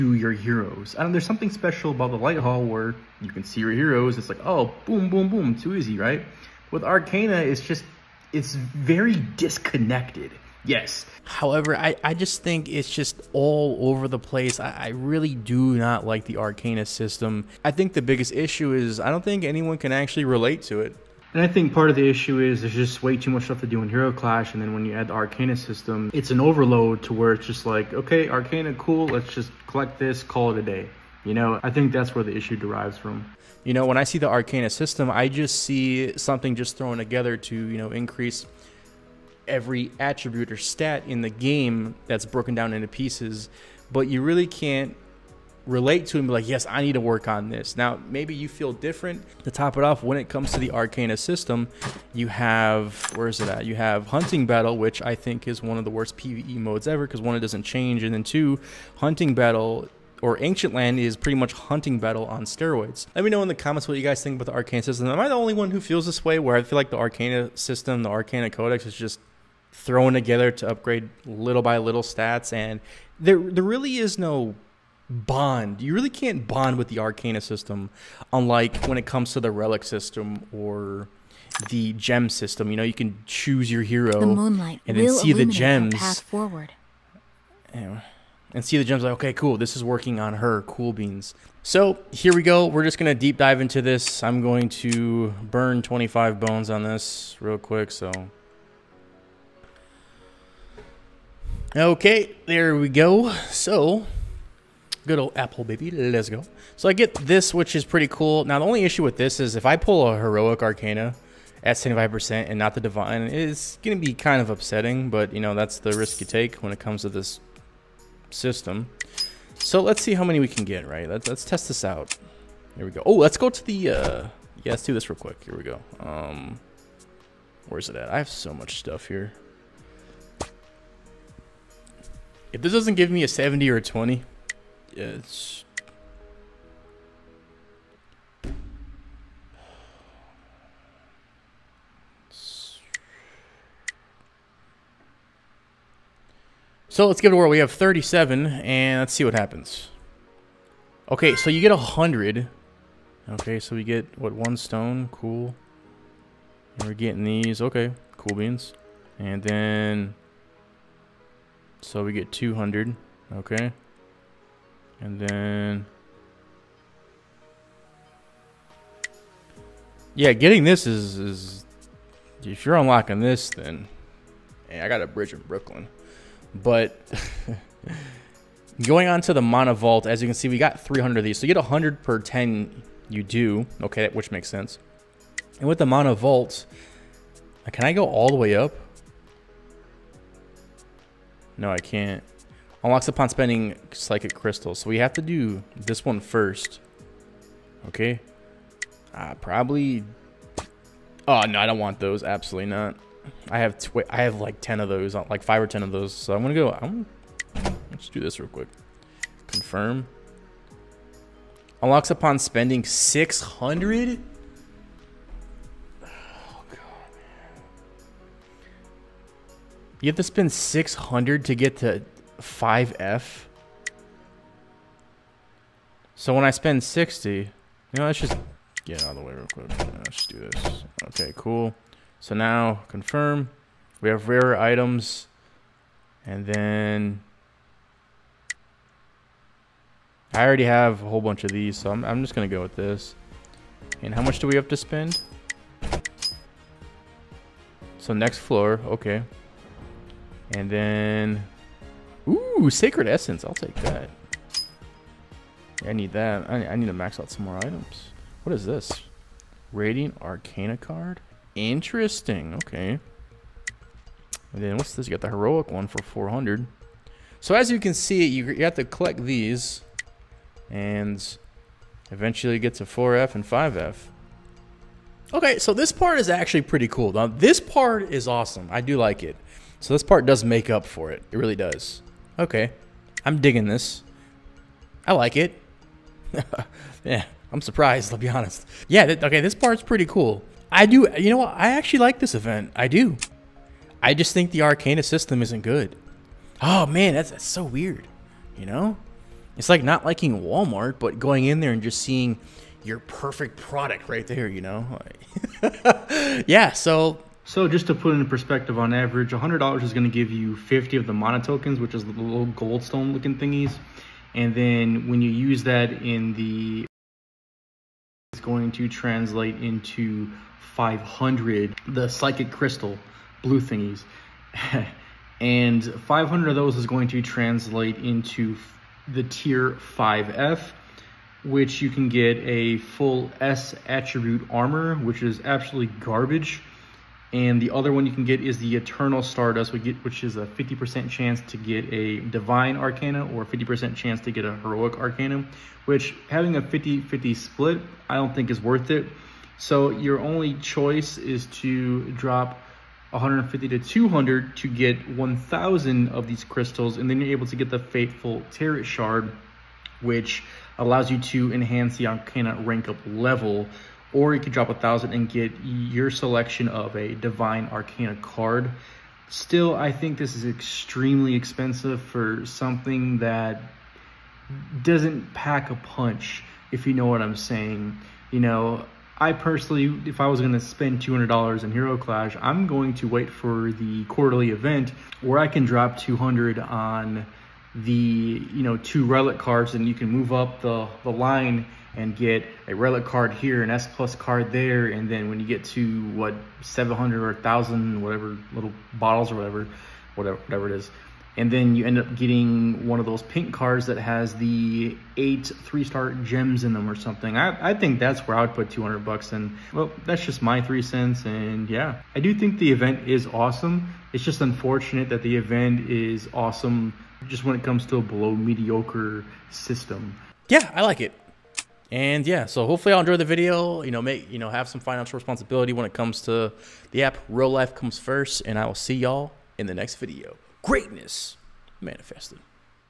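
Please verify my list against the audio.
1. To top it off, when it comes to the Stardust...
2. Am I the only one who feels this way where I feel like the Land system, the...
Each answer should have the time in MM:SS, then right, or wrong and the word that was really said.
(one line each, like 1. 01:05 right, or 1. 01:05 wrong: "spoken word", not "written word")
1. 00:49 wrong: "Arcana", not "Stardust"
2. 01:05 wrong: "Arcana", not "Land".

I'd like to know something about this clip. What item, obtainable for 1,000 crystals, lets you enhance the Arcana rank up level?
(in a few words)
Fateful Tarot Shard.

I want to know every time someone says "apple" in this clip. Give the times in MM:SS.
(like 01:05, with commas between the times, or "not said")
01:45.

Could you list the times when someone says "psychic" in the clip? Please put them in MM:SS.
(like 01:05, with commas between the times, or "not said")
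03:13, 05:22.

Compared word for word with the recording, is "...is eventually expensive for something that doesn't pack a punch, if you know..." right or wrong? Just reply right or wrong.
wrong.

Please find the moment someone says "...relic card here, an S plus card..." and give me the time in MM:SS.
06:32.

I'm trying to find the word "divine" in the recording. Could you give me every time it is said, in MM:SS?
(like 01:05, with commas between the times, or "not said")
01:52, 05:42, 06:07.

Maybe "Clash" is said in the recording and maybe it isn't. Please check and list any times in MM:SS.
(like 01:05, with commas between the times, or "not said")
00:24, 06:21.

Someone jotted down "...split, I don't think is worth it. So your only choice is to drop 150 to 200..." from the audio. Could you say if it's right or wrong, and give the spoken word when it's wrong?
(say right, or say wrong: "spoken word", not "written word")
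right.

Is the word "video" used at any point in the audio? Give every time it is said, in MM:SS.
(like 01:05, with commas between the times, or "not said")
07:03, 07:09.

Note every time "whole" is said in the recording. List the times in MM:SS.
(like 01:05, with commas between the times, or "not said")
04:01.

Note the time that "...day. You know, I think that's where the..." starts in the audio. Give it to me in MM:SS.
00:30.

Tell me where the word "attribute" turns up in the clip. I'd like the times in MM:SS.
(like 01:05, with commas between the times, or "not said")
00:39, 05:33.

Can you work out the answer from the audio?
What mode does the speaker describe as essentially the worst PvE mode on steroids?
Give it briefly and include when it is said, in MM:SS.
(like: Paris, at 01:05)
Ancient Land, at 01:00.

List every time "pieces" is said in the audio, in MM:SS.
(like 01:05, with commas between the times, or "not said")
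00:42.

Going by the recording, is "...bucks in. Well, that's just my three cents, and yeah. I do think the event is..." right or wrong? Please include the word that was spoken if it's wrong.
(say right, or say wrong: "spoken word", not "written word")
right.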